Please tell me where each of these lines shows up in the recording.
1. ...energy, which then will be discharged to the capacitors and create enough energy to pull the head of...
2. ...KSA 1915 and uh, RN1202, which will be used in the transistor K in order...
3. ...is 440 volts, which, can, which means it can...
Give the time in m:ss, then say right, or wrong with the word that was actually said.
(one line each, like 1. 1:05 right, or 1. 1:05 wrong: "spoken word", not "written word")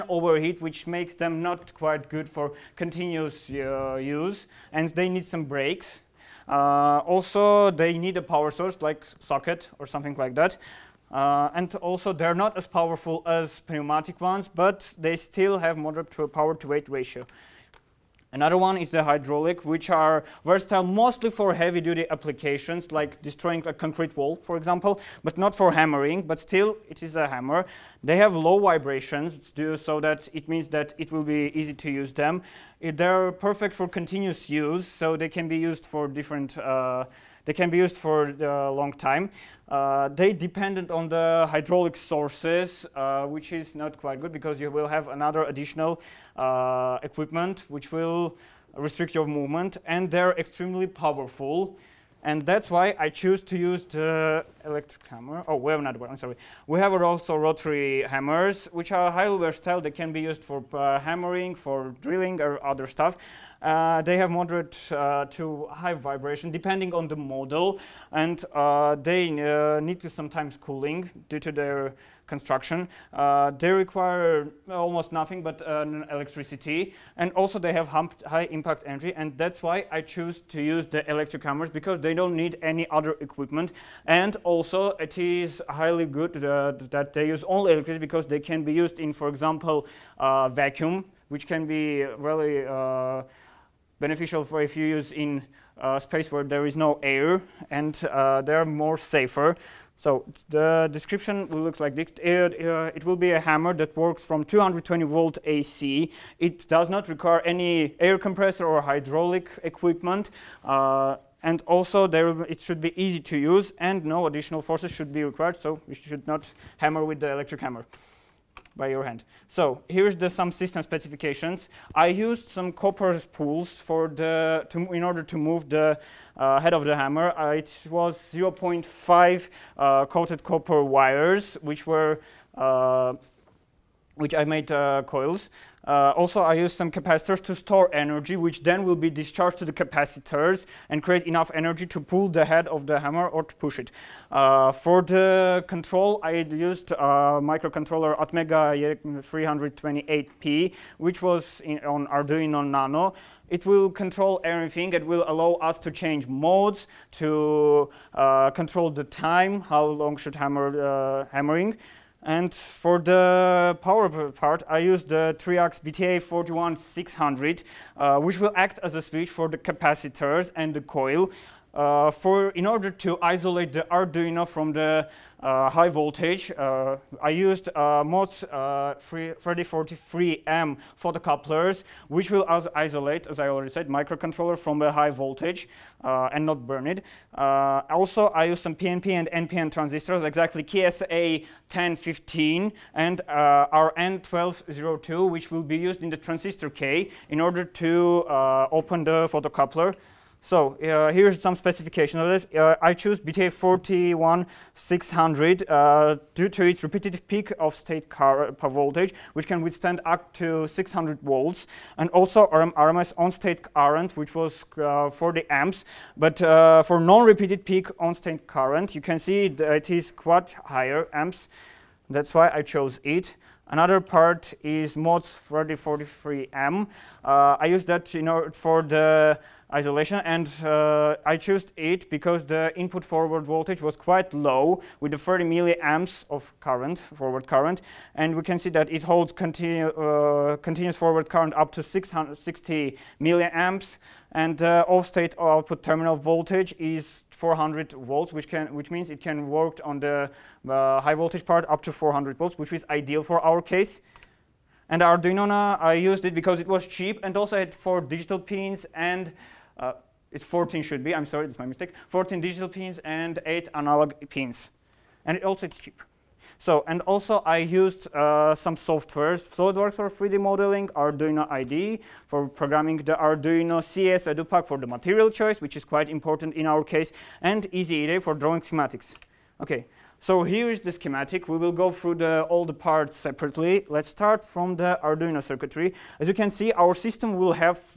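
1. 2:17 right
2. 3:10 wrong: "1015", not "1915"
3. 4:06 wrong: "400", not "440".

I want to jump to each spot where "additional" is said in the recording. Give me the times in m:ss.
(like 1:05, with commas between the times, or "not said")
0:45, 1:54.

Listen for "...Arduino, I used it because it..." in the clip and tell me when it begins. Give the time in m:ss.
4:15.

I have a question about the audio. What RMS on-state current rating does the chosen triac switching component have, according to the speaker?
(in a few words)
40 amps.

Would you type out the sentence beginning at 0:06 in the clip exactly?
Uh, also, they need a power source like socket or something like that.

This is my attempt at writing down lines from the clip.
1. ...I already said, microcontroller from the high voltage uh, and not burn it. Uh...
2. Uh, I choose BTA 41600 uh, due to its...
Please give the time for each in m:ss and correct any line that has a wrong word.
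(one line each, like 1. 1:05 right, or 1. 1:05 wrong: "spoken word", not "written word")
1. 3:03 right
2. 3:22 right.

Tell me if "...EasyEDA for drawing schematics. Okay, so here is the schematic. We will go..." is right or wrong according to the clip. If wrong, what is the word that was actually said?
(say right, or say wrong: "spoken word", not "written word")
right.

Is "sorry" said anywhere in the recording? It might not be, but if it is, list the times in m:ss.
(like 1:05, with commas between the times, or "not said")
0:56, 4:21.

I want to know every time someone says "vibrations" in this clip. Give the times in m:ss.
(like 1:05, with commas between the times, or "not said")
0:28, 1:05.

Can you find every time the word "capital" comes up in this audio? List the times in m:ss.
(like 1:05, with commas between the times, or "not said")
not said.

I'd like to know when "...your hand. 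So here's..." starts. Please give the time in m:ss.
1:58.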